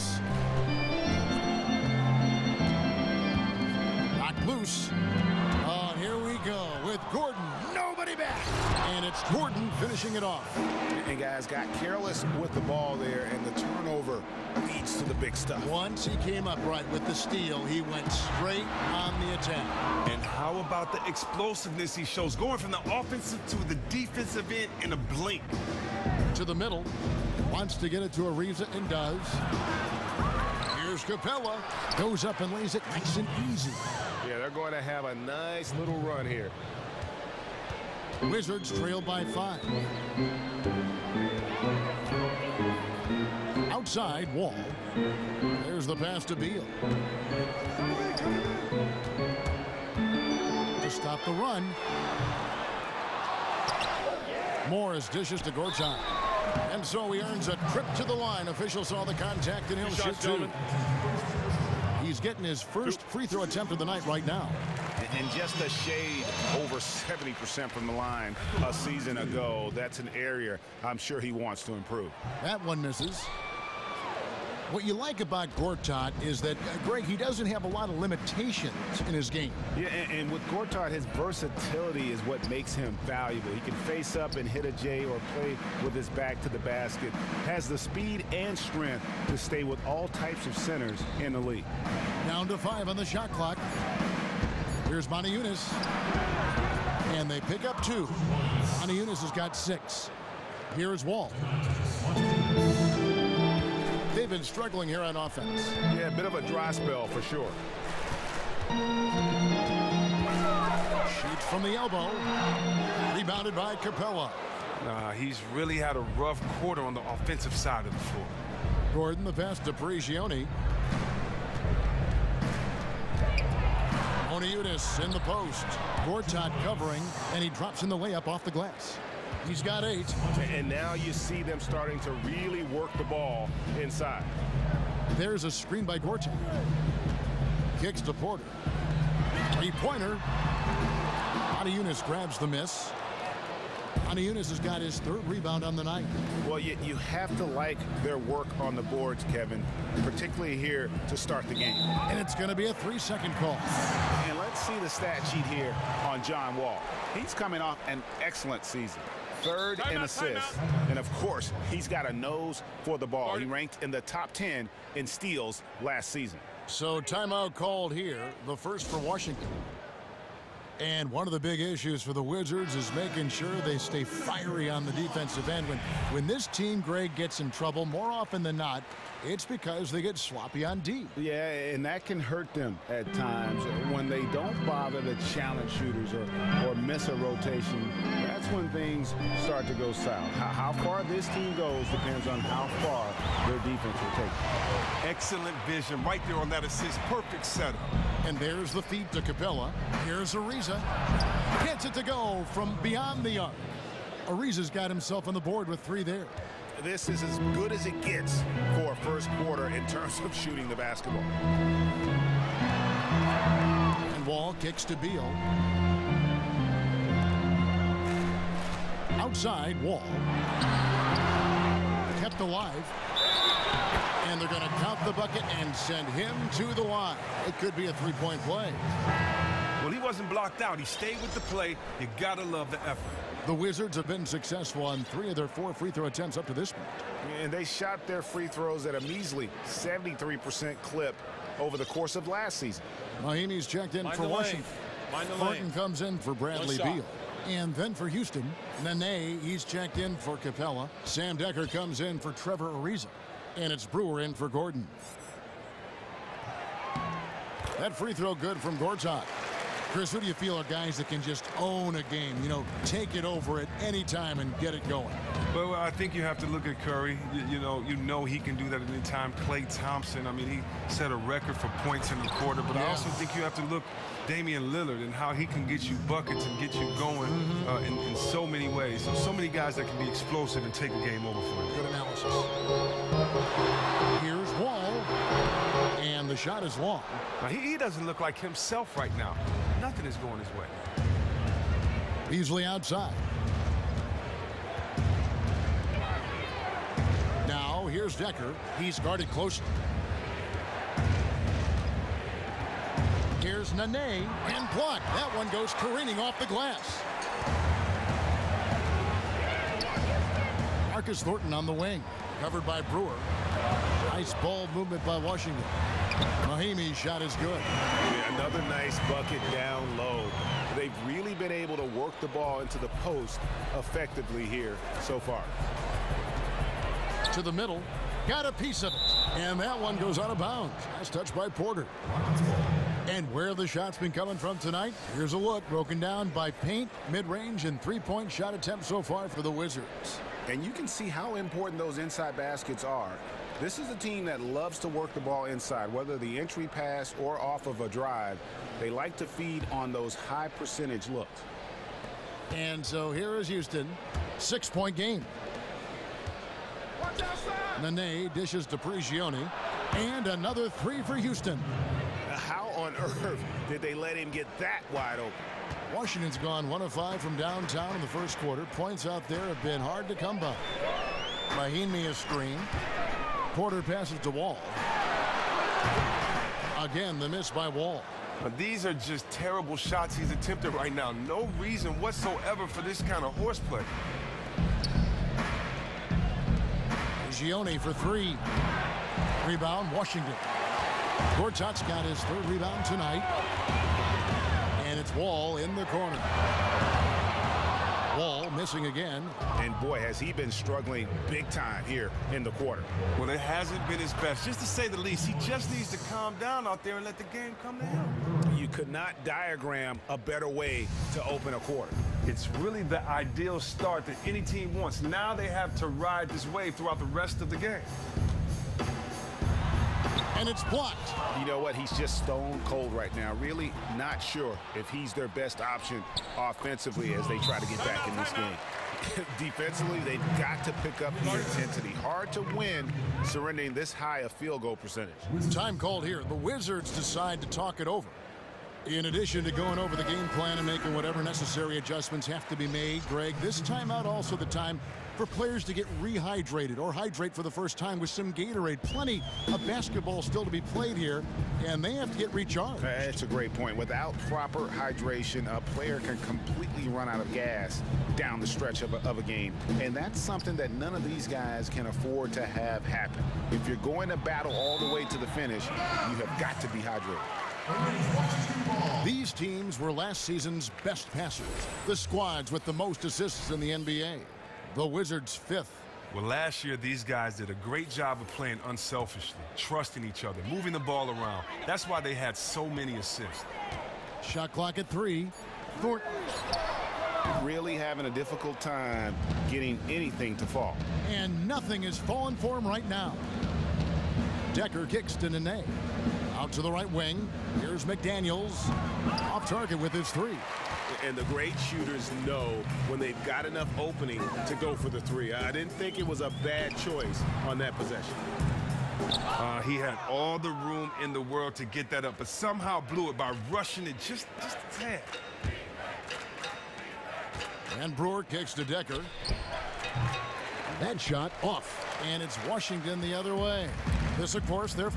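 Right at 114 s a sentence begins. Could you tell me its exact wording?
Uh, he's really had a rough quarter on the offensive side of the floor.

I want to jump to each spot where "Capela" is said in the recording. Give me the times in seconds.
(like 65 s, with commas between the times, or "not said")
31 s, 113 s, 199 s, 250 s.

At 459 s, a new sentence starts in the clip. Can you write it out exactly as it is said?
And that's something that none of these guys can afford to have happen.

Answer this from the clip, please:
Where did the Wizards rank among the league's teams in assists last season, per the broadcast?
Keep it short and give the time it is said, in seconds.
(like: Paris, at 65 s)
fifth, at 475 s.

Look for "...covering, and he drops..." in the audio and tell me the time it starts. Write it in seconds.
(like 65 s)
126 s.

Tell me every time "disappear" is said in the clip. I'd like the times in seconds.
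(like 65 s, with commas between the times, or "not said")
not said.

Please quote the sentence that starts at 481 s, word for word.
That's why they had so many assists.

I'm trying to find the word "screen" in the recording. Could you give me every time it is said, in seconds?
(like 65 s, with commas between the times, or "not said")
135 s, 372 s.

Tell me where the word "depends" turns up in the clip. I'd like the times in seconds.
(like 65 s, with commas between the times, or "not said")
191 s.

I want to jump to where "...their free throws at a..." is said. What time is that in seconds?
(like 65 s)
238 s.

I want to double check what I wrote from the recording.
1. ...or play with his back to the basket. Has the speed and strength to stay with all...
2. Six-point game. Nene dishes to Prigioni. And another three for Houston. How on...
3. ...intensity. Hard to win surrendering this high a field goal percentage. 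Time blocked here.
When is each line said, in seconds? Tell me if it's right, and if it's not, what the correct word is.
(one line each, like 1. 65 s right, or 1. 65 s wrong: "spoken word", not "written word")
1. 85 s right
2. 354 s right
3. 431 s wrong: "called", not "blocked".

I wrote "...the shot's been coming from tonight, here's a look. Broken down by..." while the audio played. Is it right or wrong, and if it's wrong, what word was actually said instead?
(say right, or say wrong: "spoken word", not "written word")
right.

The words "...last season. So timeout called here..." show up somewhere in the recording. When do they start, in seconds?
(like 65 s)
165 s.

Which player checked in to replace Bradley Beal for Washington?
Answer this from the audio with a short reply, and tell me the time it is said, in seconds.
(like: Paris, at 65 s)
Martin, at 245 s.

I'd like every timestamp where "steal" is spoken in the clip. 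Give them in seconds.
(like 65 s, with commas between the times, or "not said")
17 s, 165 s.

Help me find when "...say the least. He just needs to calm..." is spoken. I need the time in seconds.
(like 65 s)
404 s.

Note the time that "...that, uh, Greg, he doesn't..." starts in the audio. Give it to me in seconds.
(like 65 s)
76 s.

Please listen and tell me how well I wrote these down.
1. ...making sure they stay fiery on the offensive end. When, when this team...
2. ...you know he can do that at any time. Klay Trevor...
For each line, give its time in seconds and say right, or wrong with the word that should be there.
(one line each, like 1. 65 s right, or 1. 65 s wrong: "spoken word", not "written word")
1. 172 s wrong: "defensive", not "offensive"
2. 267 s wrong: "Thompson", not "Trevor".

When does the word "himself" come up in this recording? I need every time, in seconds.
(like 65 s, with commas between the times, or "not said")
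204 s, 288 s.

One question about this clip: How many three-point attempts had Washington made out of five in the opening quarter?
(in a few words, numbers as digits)
1.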